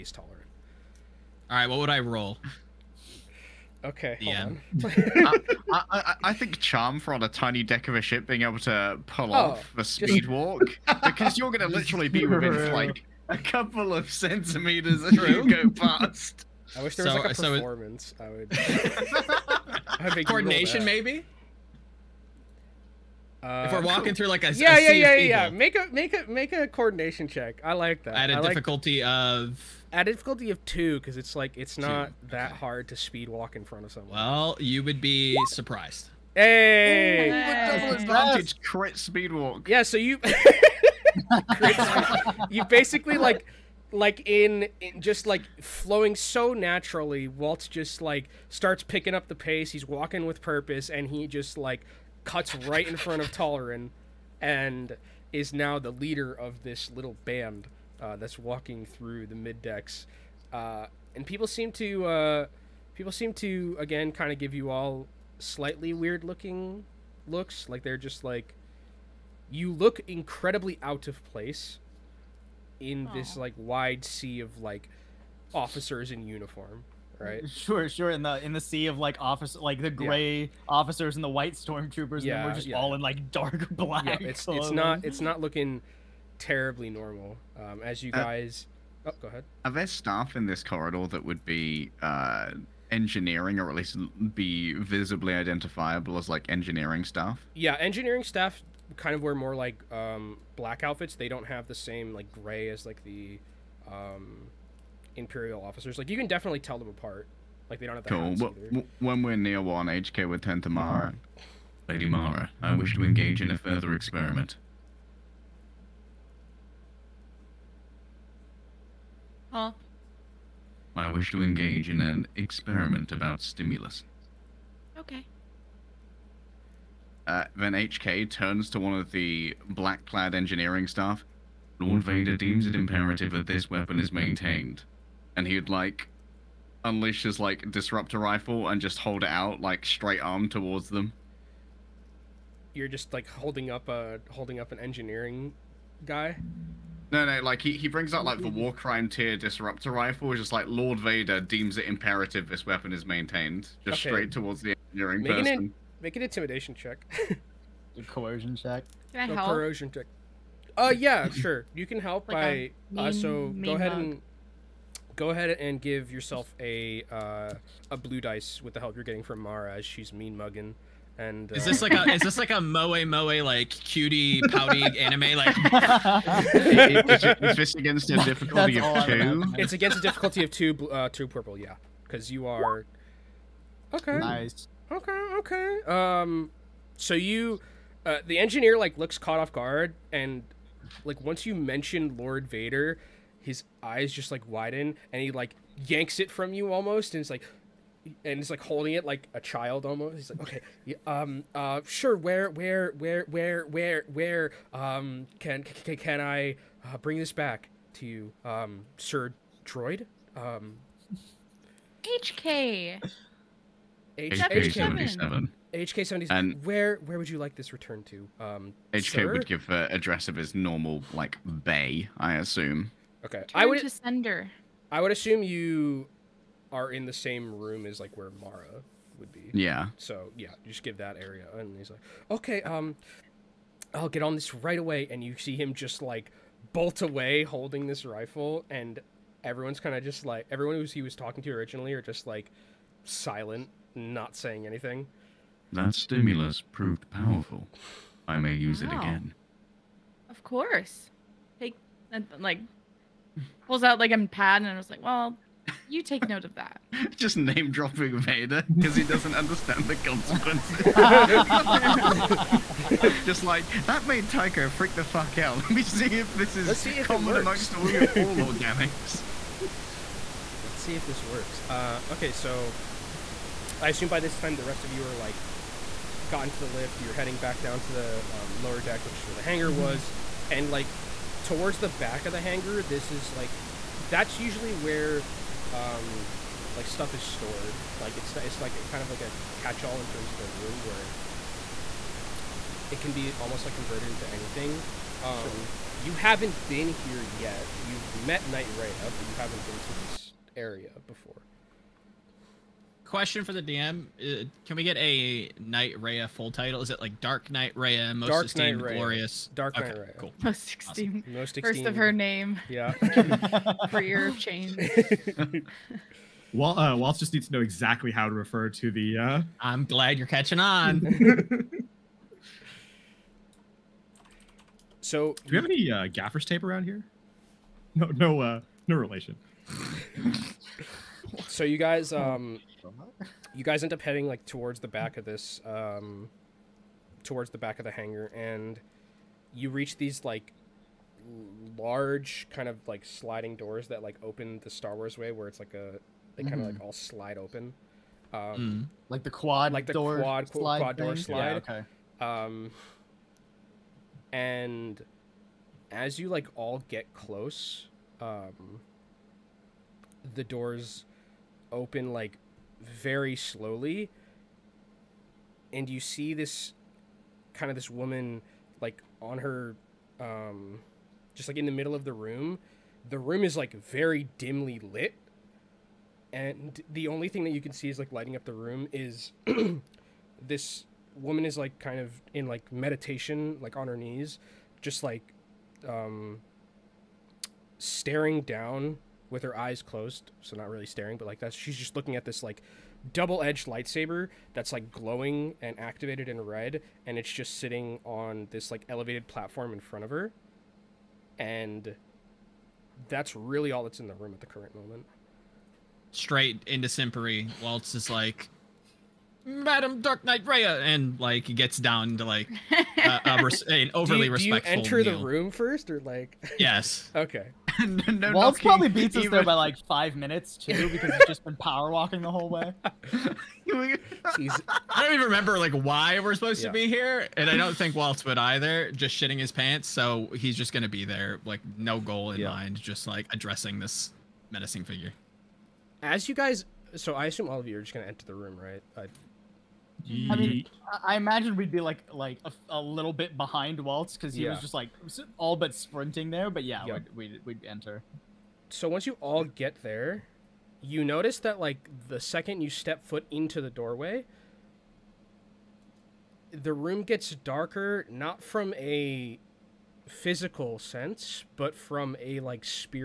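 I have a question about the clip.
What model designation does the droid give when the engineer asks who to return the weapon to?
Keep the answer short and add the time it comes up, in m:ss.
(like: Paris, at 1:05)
HK-77, at 3:35.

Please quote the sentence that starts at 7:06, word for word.
to be here, and I don't think Waltz would either.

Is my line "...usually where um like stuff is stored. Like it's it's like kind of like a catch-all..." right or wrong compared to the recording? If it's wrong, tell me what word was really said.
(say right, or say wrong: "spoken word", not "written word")
right.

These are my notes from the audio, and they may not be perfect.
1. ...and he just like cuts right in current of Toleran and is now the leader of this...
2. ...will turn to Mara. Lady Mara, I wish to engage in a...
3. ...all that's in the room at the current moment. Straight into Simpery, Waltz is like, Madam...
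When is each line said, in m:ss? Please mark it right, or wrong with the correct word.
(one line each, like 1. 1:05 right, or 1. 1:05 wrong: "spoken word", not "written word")
1. 0:50 wrong: "front", not "current"
2. 1:50 right
3. 6:43 right.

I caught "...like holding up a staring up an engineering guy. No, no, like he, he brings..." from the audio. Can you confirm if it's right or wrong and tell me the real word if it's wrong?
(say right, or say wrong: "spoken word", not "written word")
wrong: "holding", not "staring".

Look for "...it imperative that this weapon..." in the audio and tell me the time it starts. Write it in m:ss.
2:12.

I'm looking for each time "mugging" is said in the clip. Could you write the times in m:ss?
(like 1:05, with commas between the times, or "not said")
2:50.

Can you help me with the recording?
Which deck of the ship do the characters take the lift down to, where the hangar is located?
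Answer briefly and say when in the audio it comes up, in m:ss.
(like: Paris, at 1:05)
Lower deck, at 4:38.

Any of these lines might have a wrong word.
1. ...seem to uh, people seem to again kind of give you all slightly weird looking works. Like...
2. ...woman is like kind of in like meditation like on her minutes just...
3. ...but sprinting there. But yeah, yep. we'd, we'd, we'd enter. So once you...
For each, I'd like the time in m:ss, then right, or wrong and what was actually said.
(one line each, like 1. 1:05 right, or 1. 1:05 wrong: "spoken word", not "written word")
1. 1:01 wrong: "looks", not "works"
2. 6:21 wrong: "knees", not "minutes"
3. 7:25 right.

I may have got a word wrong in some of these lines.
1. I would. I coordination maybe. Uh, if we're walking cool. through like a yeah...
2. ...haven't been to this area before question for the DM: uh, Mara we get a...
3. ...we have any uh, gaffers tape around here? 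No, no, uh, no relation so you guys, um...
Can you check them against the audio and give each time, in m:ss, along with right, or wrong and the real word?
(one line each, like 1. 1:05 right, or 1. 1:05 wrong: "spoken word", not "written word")
1. 0:18 right
2. 4:59 wrong: "Can", not "Mara"
3. 5:25 right.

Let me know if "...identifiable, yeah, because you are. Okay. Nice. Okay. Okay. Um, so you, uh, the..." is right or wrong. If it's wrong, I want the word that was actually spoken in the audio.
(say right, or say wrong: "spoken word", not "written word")
wrong: "purple", not "identifiable".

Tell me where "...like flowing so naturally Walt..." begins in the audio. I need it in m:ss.
0:45.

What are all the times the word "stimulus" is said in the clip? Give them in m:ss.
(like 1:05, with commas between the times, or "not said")
2:03, 4:05.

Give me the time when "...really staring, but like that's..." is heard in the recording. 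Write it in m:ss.
6:30.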